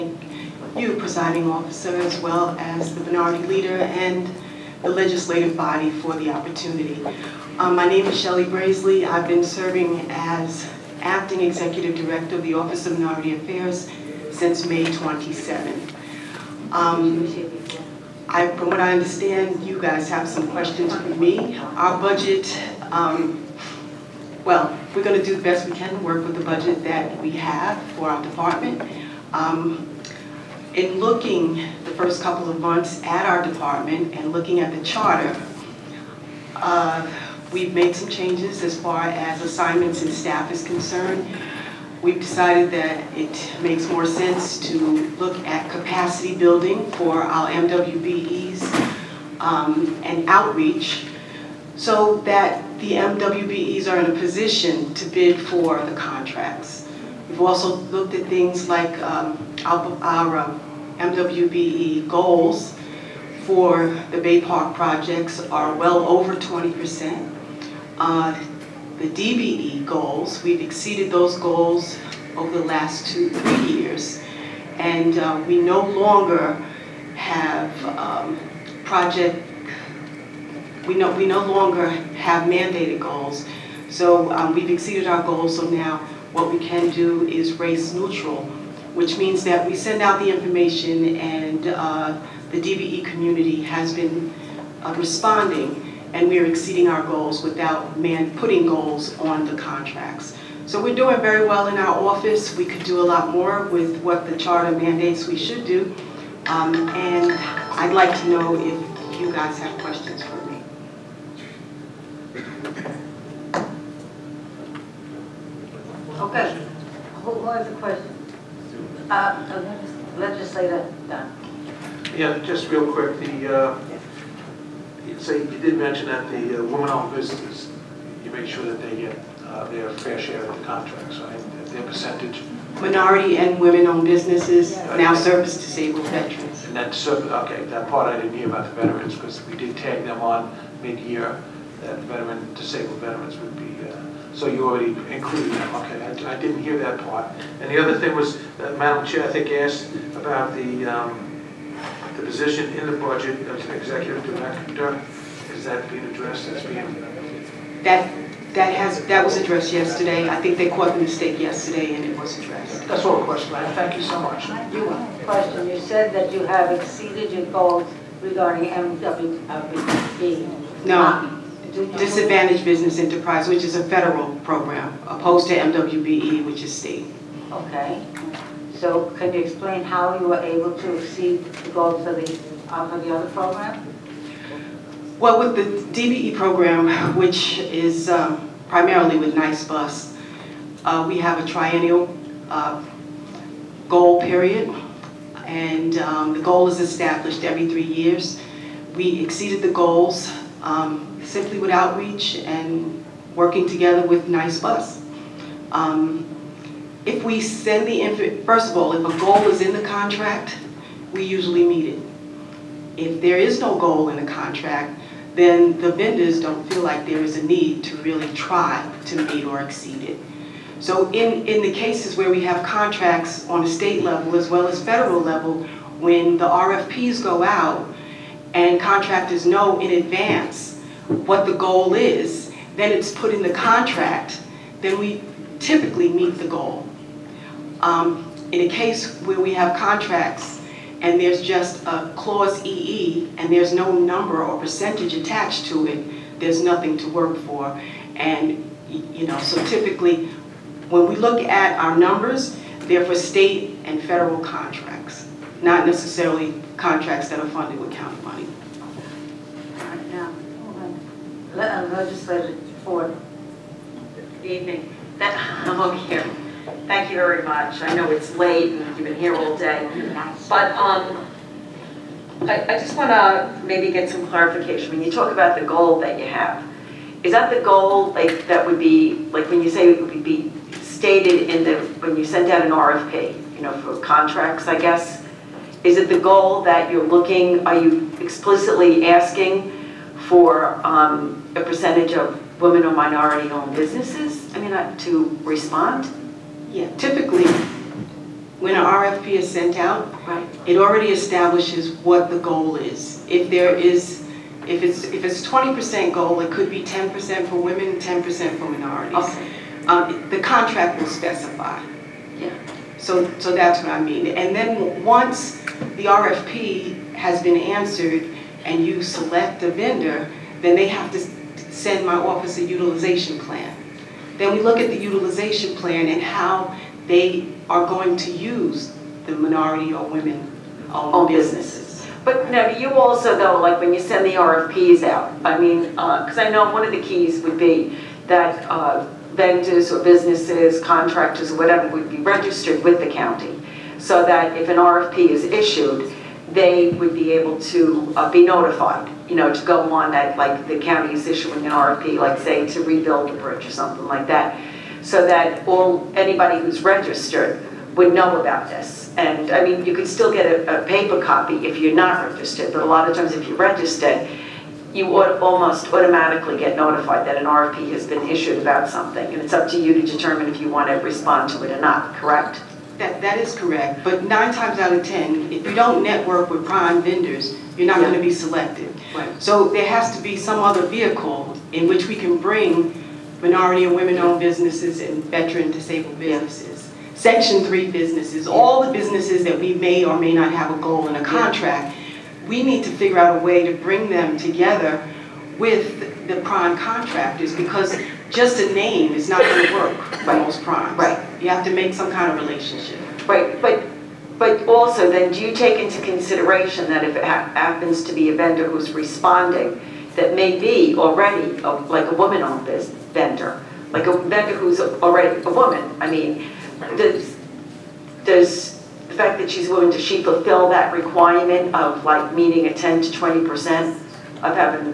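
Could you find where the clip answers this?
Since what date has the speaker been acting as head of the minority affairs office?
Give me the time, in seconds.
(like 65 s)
14 s.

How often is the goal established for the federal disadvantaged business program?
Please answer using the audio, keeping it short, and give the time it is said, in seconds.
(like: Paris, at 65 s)
every 3 years, at 197 s.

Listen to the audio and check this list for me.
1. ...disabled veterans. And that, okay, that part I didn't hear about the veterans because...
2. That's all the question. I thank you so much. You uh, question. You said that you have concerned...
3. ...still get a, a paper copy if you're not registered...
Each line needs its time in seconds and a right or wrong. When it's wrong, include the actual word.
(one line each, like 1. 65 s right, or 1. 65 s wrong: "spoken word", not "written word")
1. 135 s right
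2. 162 s wrong: "exceeded", not "concerned"
3. 360 s right.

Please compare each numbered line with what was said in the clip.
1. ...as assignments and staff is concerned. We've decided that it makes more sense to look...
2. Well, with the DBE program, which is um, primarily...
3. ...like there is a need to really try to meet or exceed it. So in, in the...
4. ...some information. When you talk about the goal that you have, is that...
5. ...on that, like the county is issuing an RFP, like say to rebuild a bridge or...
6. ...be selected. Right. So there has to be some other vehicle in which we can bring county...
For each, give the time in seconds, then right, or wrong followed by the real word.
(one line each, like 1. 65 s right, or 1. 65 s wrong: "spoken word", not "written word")
1. 39 s right
2. 185 s right
3. 216 s right
4. 274 s wrong: "clarification", not "information"
5. 349 s right
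6. 378 s wrong: "minority", not "county".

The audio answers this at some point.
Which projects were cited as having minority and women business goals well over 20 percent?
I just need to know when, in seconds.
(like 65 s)
64 s.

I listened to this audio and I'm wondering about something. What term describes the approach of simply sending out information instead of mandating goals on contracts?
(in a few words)
race neutral.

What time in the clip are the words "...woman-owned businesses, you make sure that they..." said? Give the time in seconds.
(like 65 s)
126 s.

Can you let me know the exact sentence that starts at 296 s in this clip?
Yeah, typically, when an RFP is sent out, right.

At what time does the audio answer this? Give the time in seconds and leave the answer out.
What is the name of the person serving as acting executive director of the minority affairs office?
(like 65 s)
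8 s.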